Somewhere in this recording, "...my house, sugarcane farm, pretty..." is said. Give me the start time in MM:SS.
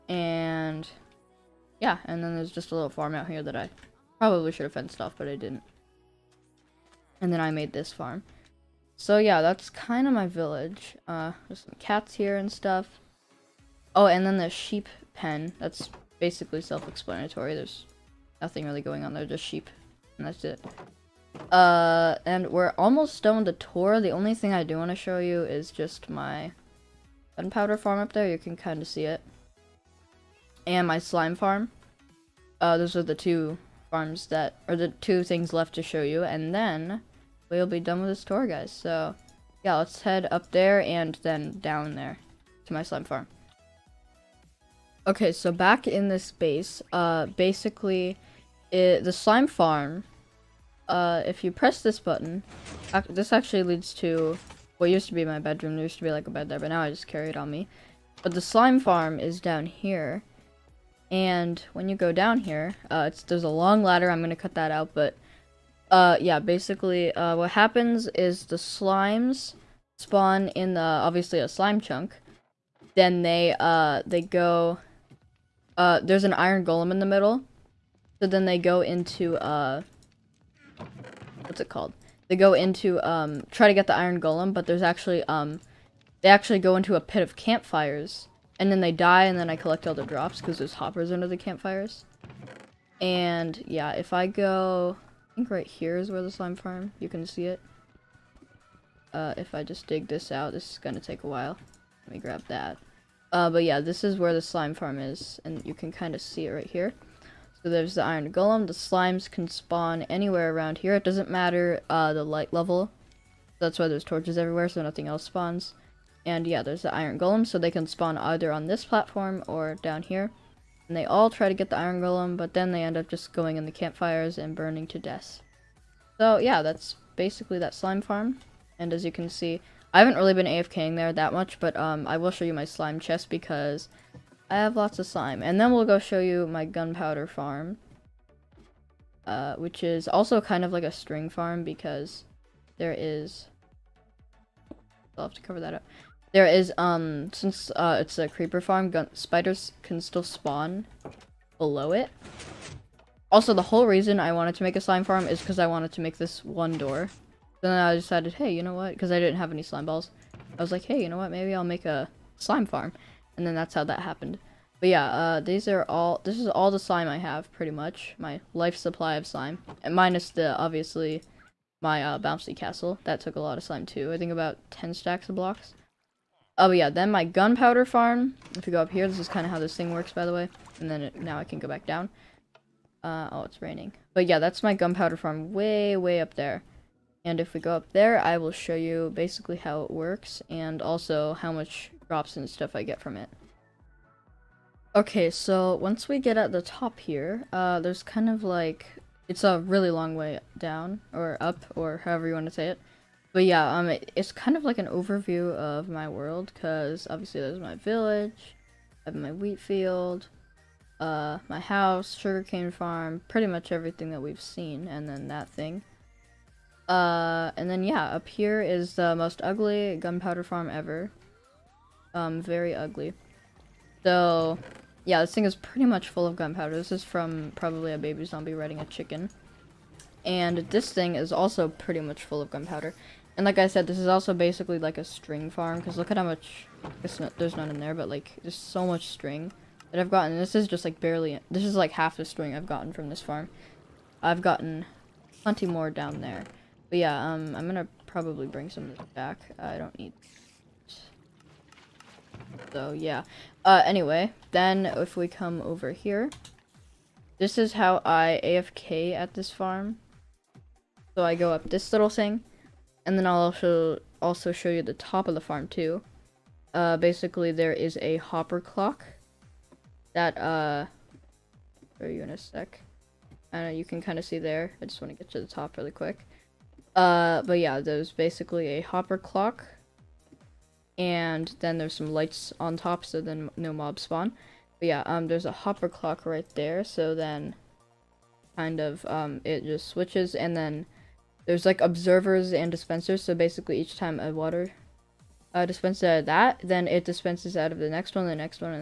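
03:31.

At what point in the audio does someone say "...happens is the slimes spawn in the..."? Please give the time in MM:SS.
01:07.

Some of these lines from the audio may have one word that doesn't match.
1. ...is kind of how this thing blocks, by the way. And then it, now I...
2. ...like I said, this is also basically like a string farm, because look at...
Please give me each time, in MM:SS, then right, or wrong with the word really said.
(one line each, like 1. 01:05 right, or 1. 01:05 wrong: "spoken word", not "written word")
1. 02:59 wrong: "works", not "blocks"
2. 03:53 right.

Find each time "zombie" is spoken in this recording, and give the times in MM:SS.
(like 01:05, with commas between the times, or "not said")
03:48.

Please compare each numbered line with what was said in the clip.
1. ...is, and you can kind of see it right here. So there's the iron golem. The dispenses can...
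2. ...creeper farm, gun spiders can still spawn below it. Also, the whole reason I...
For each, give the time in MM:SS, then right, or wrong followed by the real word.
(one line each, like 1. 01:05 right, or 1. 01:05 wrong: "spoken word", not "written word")
1. 01:44 wrong: "slimes", not "dispenses"
2. 02:28 right.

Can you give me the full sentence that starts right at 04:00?
This is just like barely, this is like half the string I've gotten from this farm.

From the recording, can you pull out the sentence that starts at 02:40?
I was like, hey, you know what?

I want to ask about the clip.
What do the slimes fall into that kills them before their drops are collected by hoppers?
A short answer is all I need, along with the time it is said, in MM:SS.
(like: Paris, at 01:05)
A pit of campfires, at 01:26.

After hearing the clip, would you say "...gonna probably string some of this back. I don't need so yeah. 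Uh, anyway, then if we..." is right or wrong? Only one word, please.
wrong.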